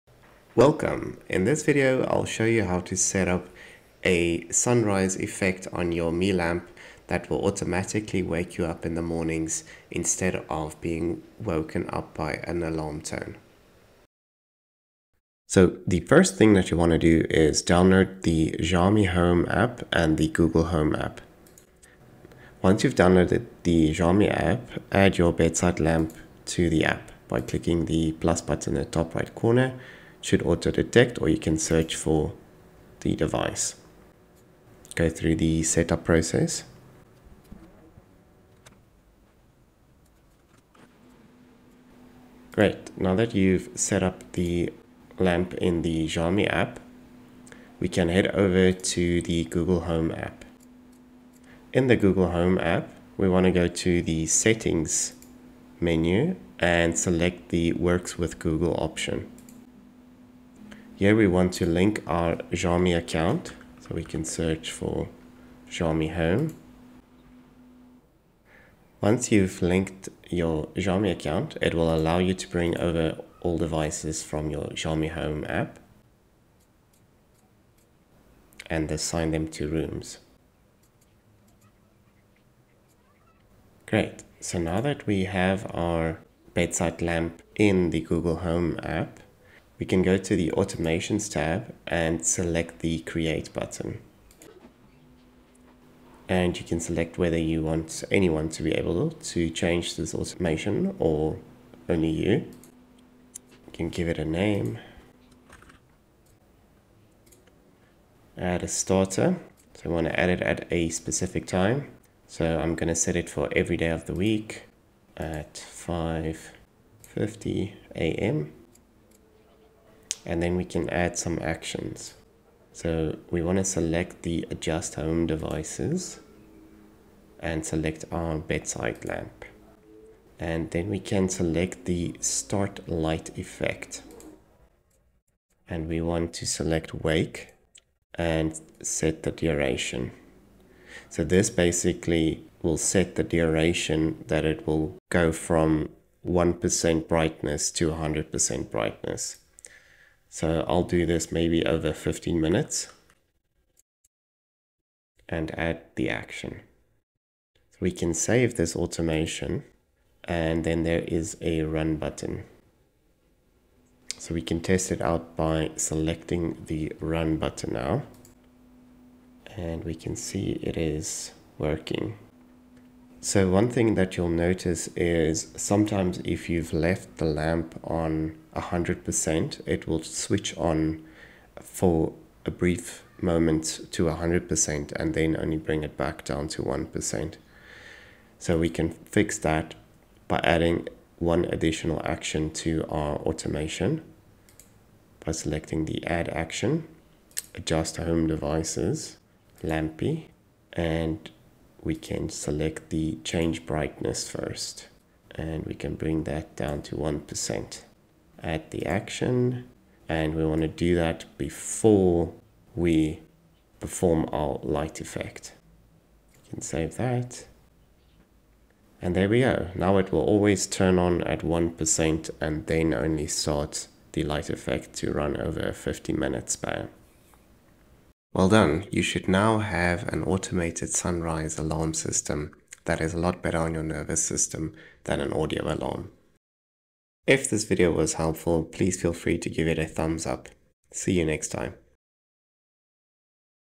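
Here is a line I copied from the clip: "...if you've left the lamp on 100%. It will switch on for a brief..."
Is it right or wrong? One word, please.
right.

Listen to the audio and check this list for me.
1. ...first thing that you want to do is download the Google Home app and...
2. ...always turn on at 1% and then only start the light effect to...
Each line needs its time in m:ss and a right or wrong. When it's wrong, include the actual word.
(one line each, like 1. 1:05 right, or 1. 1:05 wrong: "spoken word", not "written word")
1. 0:16 wrong: "Xiaomi", not "Google"
2. 3:40 right.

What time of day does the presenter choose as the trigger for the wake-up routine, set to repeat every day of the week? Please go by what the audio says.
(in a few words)
5:50 a.m.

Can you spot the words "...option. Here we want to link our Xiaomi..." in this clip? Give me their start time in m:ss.
0:58.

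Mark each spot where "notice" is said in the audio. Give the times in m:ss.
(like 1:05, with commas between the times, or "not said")
2:54.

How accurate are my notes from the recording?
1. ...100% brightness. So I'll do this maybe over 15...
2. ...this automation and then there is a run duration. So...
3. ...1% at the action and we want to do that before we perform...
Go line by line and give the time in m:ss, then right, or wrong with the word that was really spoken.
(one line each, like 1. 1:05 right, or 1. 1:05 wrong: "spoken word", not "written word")
1. 2:27 right
2. 2:38 wrong: "button", not "duration"
3. 3:26 right.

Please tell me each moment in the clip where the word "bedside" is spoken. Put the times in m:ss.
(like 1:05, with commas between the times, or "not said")
0:25, 1:26, 2:08.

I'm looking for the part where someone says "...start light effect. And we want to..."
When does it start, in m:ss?
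2:12.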